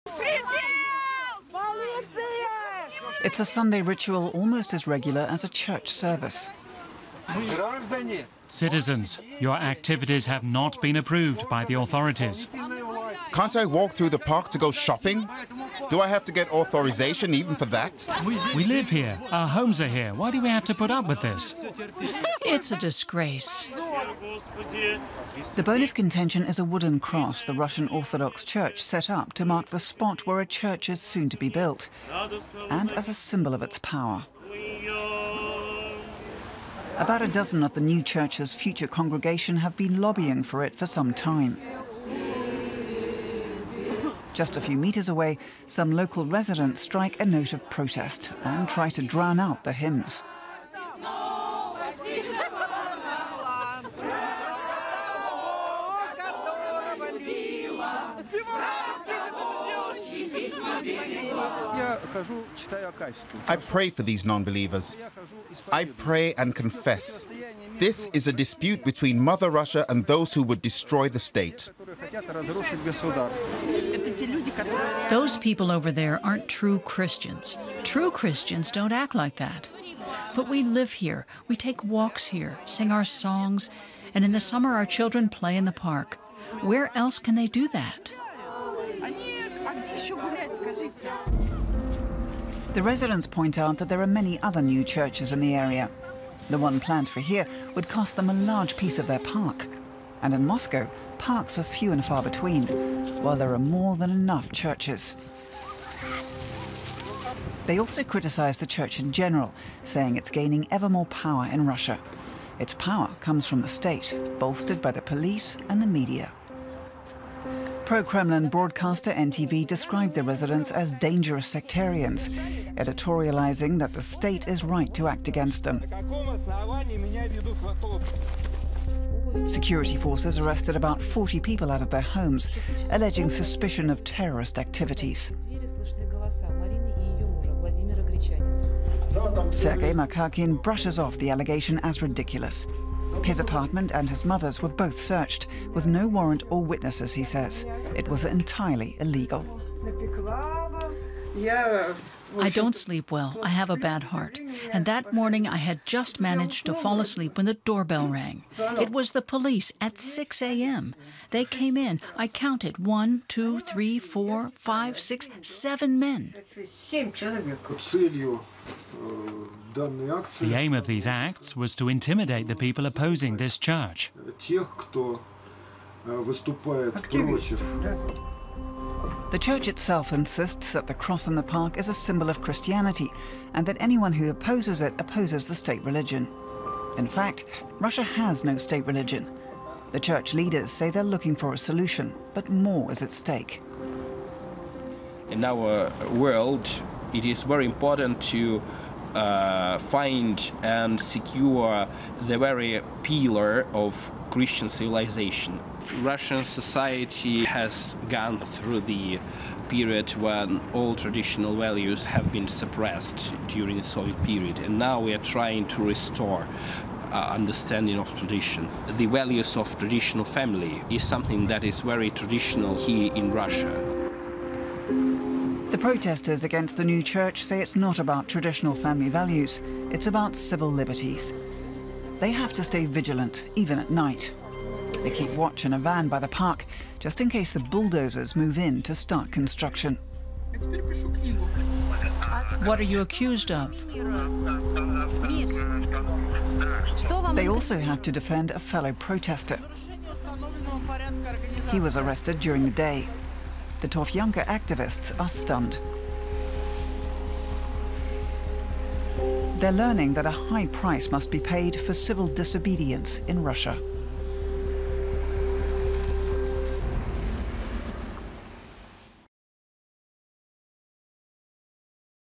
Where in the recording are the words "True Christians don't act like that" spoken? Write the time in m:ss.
1:17.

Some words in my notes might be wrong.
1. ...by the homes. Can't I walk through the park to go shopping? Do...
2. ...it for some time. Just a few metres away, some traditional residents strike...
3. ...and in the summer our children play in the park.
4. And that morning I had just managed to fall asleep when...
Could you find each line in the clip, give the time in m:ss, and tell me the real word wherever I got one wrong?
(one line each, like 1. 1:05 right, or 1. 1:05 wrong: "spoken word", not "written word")
1. 0:11 wrong: "authorities", not "homes"
2. 0:40 wrong: "local", not "traditional"
3. 1:24 right
4. 2:34 right.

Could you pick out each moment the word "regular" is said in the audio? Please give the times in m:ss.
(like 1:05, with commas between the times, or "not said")
0:04.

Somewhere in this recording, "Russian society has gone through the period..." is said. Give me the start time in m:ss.
3:26.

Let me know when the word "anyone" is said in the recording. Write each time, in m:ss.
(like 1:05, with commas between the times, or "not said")
3:03.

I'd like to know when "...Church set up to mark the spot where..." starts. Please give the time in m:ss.
0:28.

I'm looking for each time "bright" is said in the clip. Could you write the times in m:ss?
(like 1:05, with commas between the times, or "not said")
not said.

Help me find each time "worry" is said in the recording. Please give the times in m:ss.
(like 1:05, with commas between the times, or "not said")
not said.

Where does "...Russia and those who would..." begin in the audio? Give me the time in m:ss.
1:09.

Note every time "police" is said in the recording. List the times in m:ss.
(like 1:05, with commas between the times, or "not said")
1:55, 2:39.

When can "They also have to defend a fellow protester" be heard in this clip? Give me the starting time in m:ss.
4:07.